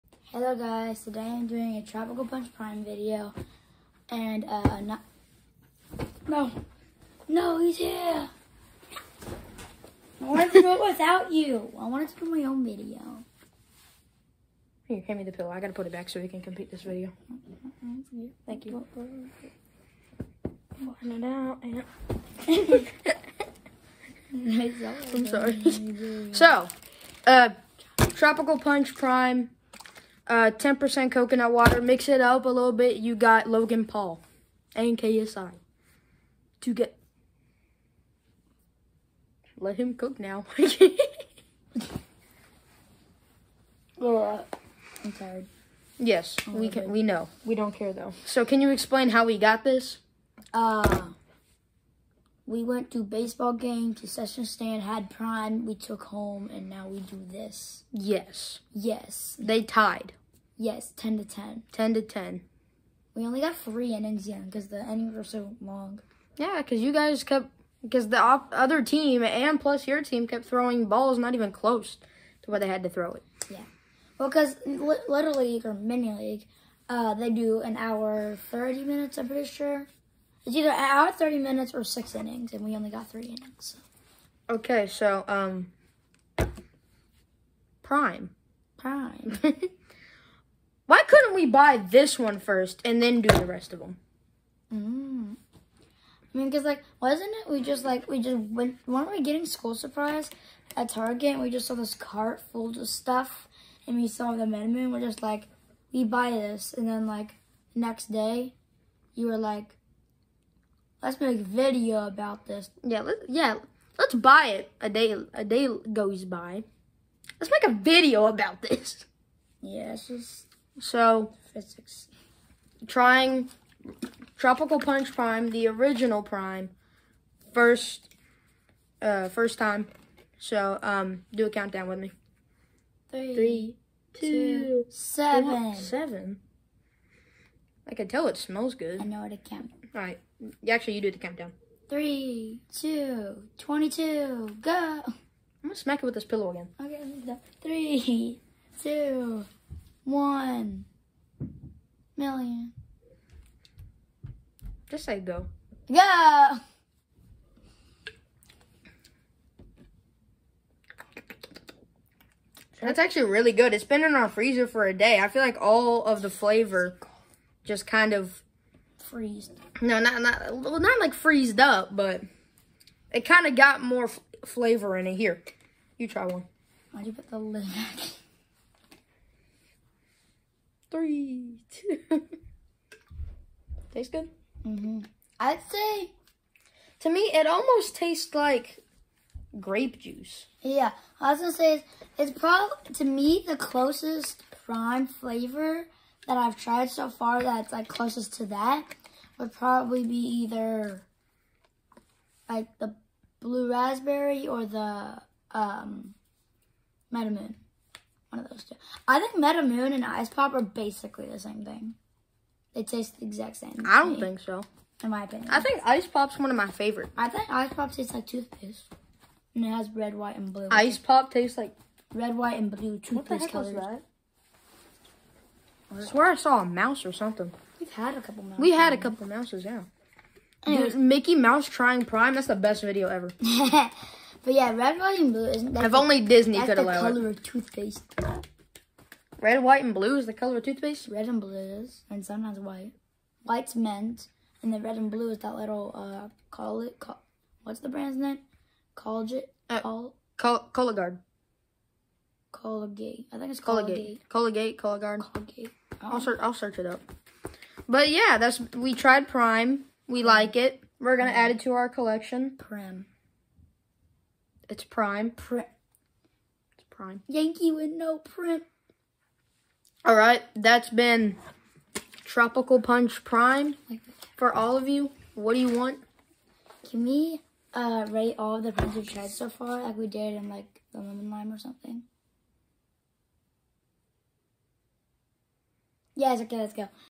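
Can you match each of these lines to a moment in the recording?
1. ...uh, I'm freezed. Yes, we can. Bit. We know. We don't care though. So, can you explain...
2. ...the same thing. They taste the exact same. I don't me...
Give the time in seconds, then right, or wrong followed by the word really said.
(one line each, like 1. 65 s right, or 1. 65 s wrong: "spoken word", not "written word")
1. 44 s wrong: "tired", not "freezed"
2. 211 s right.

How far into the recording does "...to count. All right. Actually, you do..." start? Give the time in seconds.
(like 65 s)
139 s.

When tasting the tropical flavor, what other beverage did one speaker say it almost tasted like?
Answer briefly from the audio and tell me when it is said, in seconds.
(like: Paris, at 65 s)
grape juice, at 189 s.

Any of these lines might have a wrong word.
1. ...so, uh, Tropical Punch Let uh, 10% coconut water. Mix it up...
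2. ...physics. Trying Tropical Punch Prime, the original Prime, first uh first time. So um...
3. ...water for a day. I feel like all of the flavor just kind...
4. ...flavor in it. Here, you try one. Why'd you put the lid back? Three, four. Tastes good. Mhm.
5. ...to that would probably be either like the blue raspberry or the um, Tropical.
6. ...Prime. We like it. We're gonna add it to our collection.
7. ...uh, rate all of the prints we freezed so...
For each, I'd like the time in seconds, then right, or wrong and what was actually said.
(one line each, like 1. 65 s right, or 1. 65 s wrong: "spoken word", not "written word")
1. 26 s wrong: "Prime", not "Let"
2. 121 s right
3. 164 s wrong: "freezer", not "water"
4. 174 s wrong: "two", not "four"
5. 198 s wrong: "Metamoon", not "Tropical"
6. 259 s right
7. 277 s wrong: "tried", not "freezed".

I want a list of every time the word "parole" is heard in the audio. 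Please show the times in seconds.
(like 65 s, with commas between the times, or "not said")
not said.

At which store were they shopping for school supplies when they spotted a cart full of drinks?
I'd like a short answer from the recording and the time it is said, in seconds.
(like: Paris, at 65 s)
Target, at 100 s.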